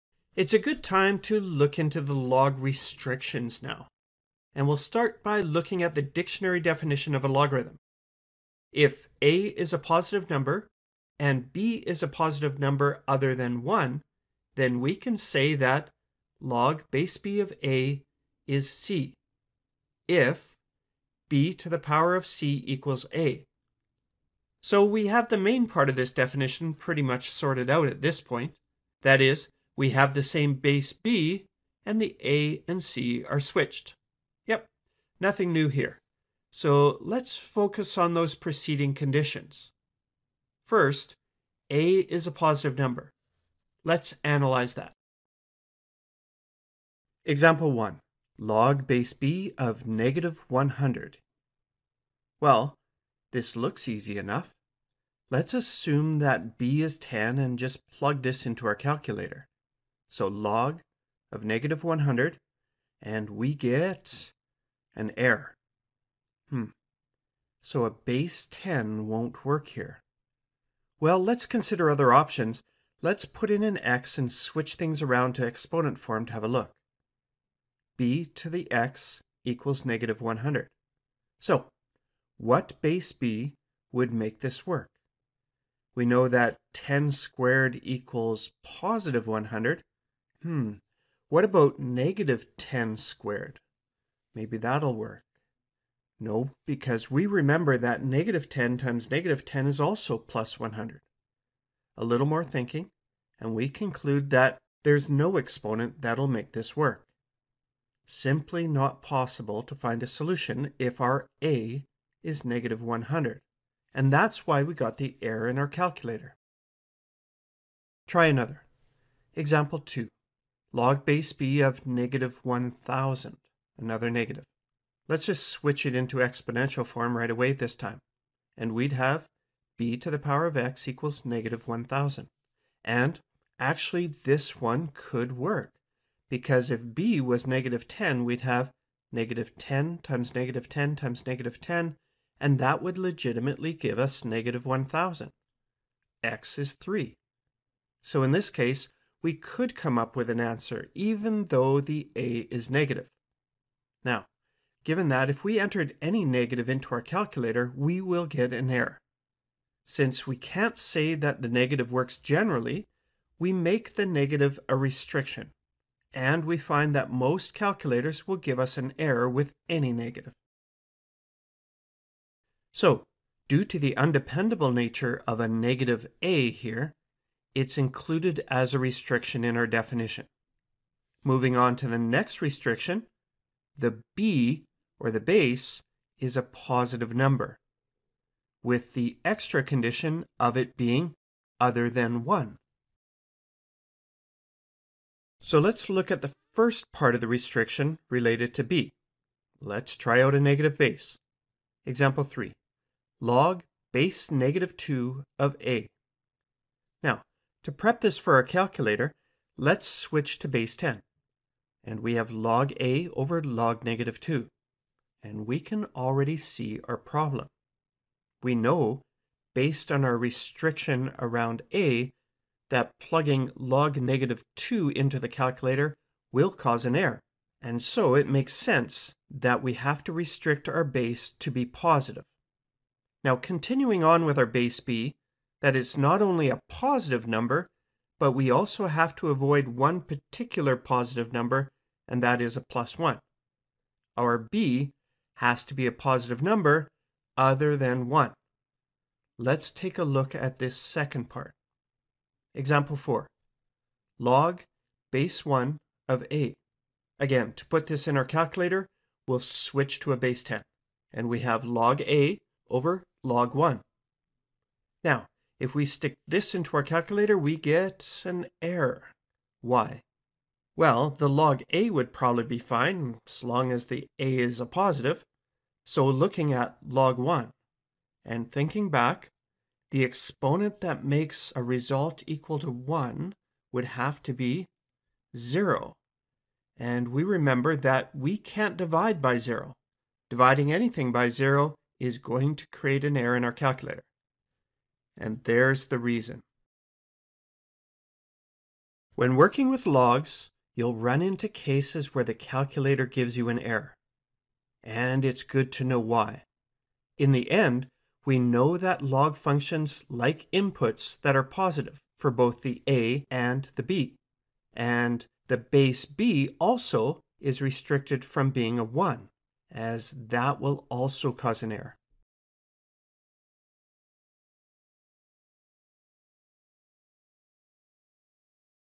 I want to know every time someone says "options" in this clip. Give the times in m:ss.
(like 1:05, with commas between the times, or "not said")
1:12.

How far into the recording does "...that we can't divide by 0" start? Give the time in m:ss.
4:47.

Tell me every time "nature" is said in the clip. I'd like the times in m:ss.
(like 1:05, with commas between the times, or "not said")
2:54.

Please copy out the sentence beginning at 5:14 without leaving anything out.
And the base b also is restricted from being a 1, as that will also cause an error.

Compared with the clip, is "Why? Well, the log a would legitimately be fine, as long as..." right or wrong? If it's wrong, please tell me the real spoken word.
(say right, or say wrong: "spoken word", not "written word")
wrong: "probably", not "legitimately".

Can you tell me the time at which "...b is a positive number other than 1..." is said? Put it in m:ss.
0:11.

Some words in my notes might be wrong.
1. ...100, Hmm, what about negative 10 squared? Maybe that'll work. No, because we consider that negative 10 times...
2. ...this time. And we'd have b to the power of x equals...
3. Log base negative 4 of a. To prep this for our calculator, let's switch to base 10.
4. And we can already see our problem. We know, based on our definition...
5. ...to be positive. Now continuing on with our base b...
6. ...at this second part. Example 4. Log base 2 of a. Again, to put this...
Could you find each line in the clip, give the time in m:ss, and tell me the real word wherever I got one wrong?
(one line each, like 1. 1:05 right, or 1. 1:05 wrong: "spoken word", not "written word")
1. 1:29 wrong: "remember", not "consider"
2. 2:07 right
3. 3:23 wrong: "2", not "4"
4. 3:35 wrong: "restriction", not "definition"
5. 3:51 right
6. 4:10 wrong: "1", not "2".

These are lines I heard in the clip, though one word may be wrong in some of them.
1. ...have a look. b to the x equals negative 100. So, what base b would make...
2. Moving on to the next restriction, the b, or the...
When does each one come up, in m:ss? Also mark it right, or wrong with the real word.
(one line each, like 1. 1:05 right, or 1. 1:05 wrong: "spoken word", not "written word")
1. 1:16 right
2. 3:01 right.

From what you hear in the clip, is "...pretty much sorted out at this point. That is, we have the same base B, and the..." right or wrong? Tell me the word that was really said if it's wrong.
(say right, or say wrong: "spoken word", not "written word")
right.